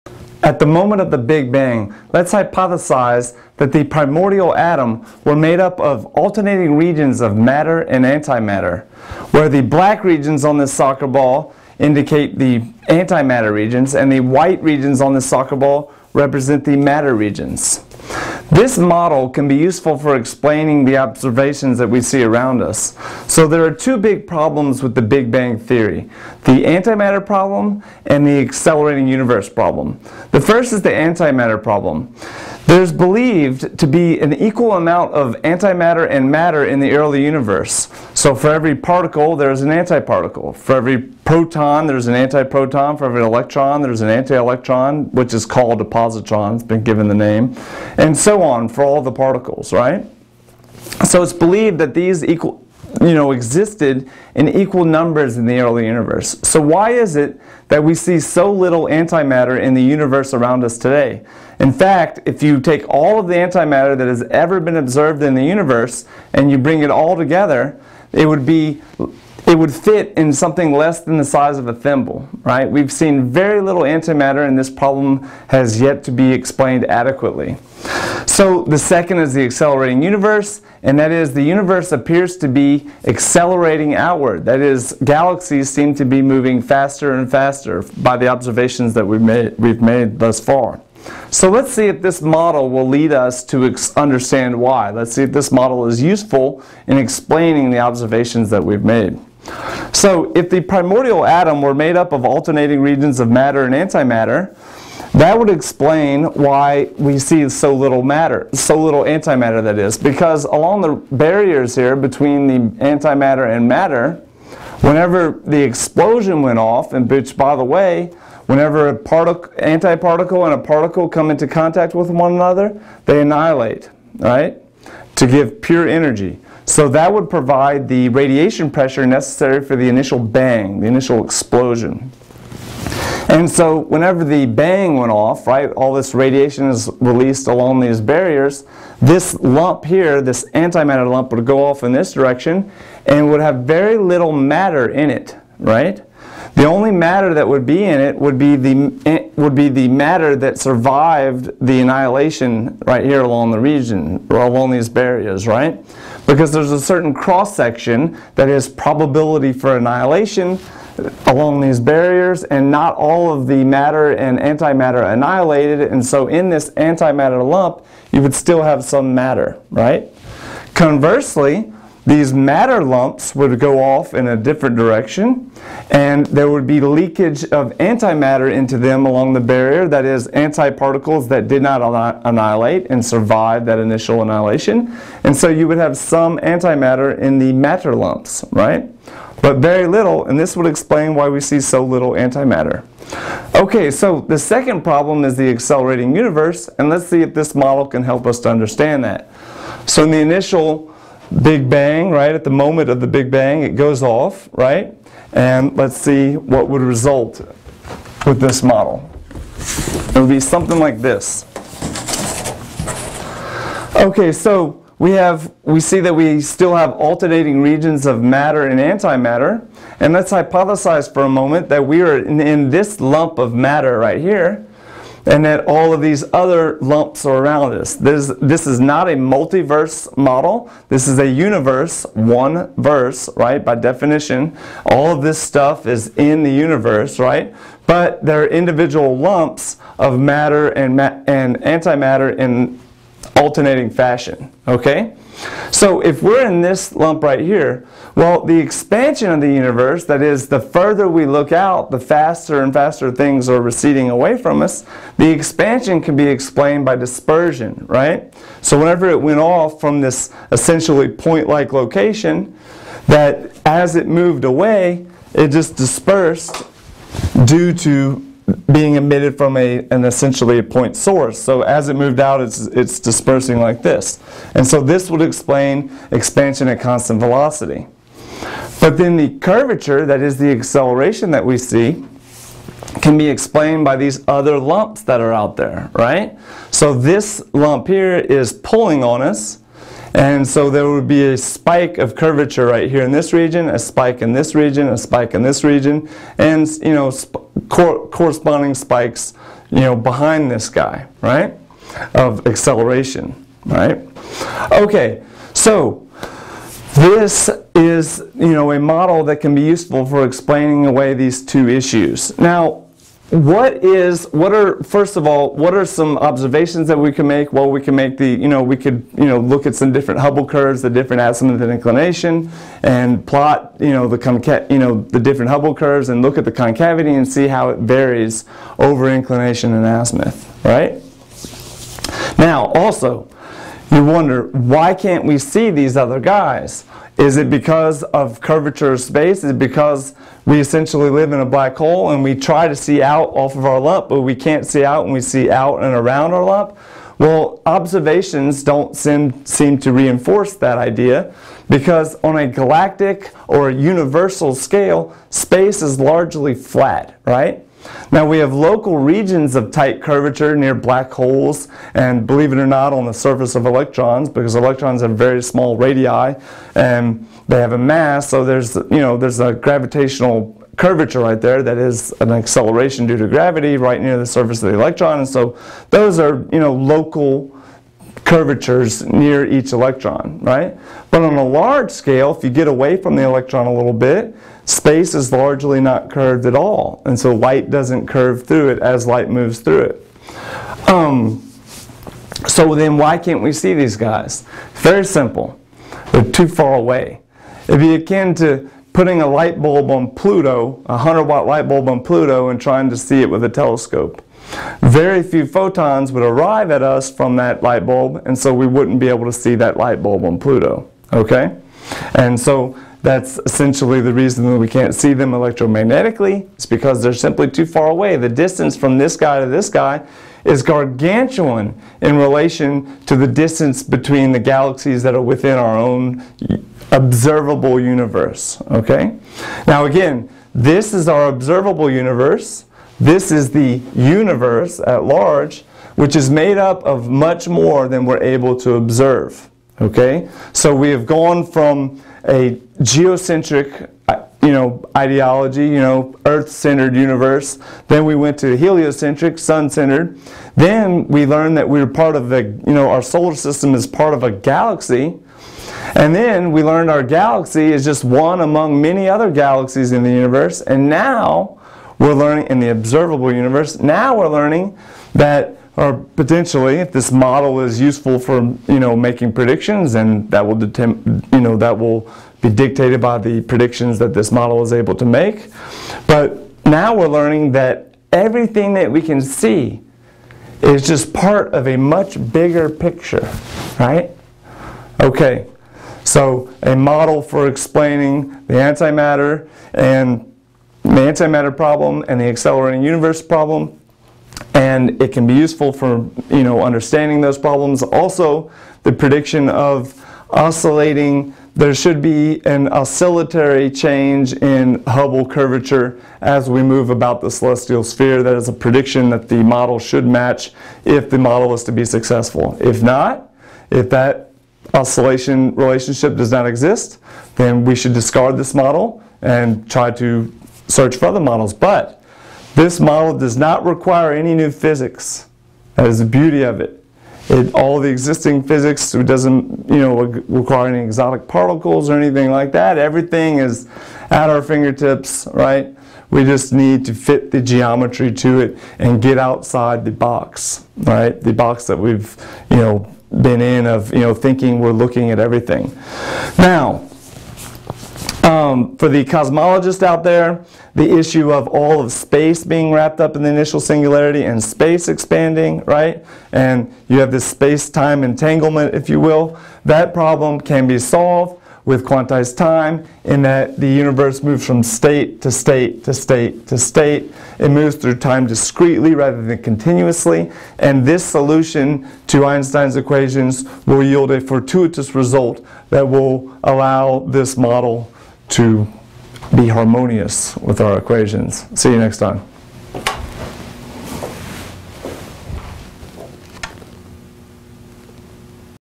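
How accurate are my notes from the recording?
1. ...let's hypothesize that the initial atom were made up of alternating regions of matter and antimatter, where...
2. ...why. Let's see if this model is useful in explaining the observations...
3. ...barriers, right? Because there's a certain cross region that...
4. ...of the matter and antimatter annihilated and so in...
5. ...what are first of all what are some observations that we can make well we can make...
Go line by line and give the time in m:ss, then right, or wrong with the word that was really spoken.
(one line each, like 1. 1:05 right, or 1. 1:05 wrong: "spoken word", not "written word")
1. 0:02 wrong: "primordial", not "initial"
2. 1:34 right
3. 2:34 wrong: "section", not "region"
4. 2:43 right
5. 5:14 right.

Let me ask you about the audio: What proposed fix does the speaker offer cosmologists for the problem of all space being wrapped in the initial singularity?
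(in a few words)
quantized time.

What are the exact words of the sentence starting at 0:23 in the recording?
So there are two big problems with the Big Bang Theory, the antimatter problem and the accelerating universe problem.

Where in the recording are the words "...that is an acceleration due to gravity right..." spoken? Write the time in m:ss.
6:11.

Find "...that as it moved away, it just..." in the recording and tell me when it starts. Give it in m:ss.
4:23.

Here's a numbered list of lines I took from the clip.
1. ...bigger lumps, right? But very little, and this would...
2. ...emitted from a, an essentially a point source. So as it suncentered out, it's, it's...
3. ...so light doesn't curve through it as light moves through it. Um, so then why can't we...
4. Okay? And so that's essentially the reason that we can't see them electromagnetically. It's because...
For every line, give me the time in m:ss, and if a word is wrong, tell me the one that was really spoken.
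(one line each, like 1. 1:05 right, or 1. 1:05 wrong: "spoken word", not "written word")
1. 3:07 wrong: "matter", not "bigger"
2. 4:28 wrong: "moved", not "suncentered"
3. 6:27 right
4. 6:51 right.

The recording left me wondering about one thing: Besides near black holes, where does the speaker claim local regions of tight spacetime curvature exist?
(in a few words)
surface of electrons.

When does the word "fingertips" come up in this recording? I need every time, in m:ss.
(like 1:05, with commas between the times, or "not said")
8:54.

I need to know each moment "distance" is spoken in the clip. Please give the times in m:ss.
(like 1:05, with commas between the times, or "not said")
6:58, 7:03.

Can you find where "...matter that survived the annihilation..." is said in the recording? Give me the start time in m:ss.
2:29.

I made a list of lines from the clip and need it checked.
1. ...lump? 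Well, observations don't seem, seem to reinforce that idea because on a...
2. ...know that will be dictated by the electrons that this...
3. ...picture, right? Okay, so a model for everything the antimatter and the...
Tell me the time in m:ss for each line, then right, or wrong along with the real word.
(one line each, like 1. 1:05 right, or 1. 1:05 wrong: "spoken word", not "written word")
1. 5:46 right
2. 7:51 wrong: "predictions", not "electrons"
3. 8:02 wrong: "explaining", not "everything".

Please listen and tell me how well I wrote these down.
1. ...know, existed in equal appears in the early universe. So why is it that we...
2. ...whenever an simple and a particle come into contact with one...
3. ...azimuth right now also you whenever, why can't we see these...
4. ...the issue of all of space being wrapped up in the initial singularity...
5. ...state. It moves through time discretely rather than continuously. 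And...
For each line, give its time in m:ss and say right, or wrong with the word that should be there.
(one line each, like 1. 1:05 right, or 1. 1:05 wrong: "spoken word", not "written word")
1. 0:53 wrong: "numbers", not "appears"
2. 1:58 wrong: "antiparticle", not "simple"
3. 5:29 wrong: "wonder", not "whenever"
4. 9:10 right
5. 9:26 right.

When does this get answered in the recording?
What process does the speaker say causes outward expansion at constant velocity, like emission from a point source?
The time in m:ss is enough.
4:16.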